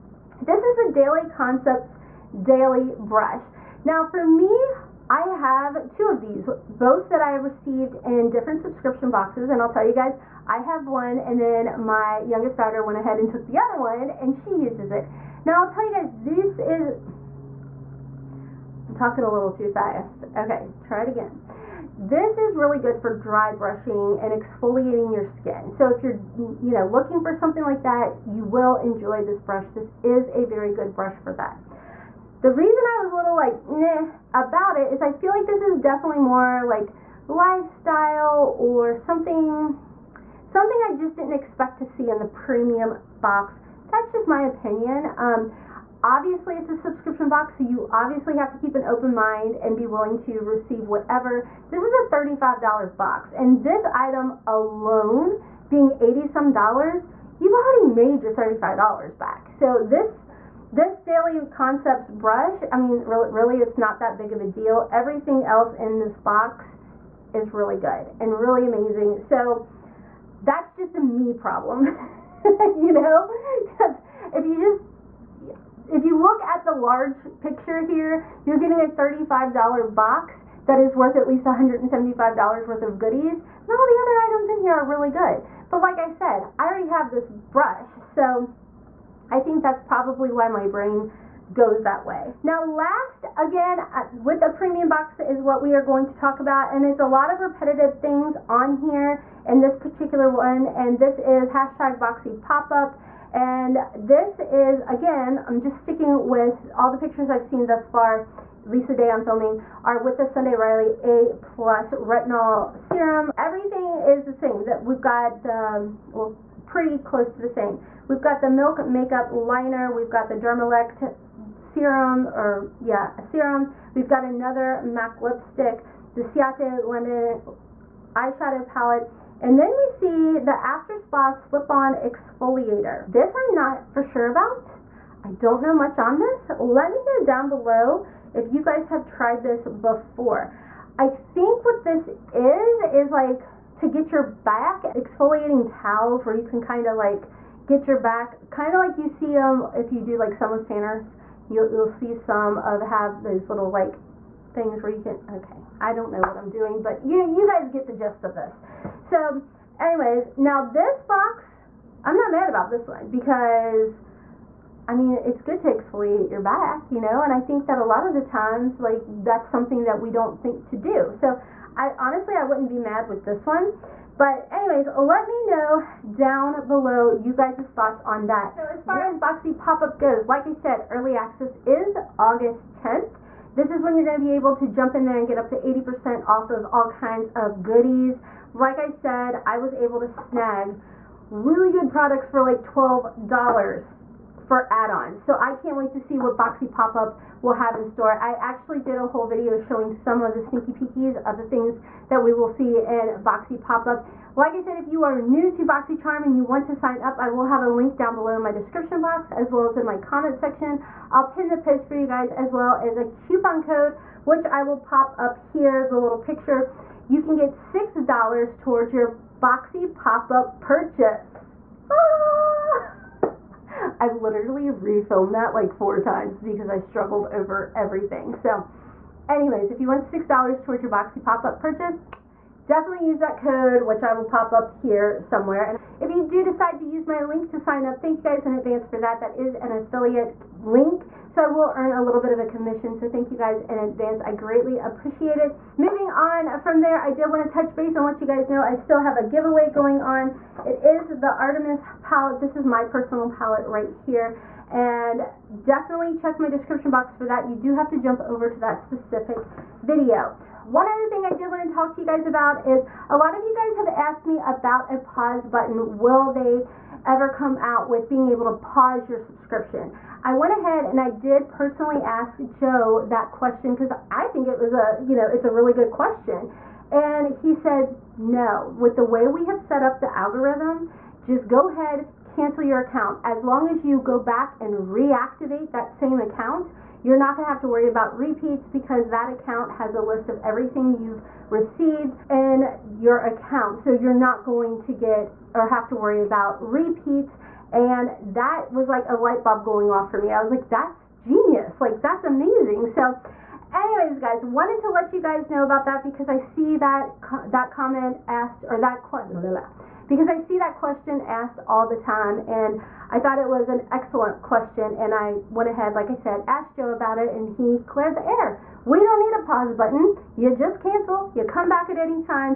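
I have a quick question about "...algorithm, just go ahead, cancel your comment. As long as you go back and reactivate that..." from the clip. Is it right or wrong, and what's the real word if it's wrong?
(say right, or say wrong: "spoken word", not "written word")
wrong: "account", not "comment".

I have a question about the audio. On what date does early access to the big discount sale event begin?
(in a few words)
August 10th.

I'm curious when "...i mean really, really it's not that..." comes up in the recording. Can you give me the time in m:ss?
1:02.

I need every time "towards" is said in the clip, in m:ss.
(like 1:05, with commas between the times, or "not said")
3:38, 3:50.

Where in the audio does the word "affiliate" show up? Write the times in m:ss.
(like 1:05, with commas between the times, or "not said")
3:59.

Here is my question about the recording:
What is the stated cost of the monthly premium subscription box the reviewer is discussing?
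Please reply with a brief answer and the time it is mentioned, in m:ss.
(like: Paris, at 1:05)
$35, at 0:51.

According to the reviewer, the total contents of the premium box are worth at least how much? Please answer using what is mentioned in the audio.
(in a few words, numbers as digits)
$175.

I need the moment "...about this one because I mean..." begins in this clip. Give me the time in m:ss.
2:42.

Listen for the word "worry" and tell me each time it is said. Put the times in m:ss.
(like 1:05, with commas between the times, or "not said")
4:47, 4:55.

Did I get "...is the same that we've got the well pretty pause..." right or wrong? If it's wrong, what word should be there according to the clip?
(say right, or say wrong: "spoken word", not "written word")
wrong: "close", not "pause".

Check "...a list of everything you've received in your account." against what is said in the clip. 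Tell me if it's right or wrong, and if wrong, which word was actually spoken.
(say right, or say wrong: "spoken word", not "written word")
right.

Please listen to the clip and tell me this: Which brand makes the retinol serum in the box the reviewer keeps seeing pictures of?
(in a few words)
Sunday Riley.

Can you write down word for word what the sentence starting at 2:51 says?
So, I honestly, I wouldn't be mad with this one.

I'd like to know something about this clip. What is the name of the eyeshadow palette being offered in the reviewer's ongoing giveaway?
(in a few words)
Artemis.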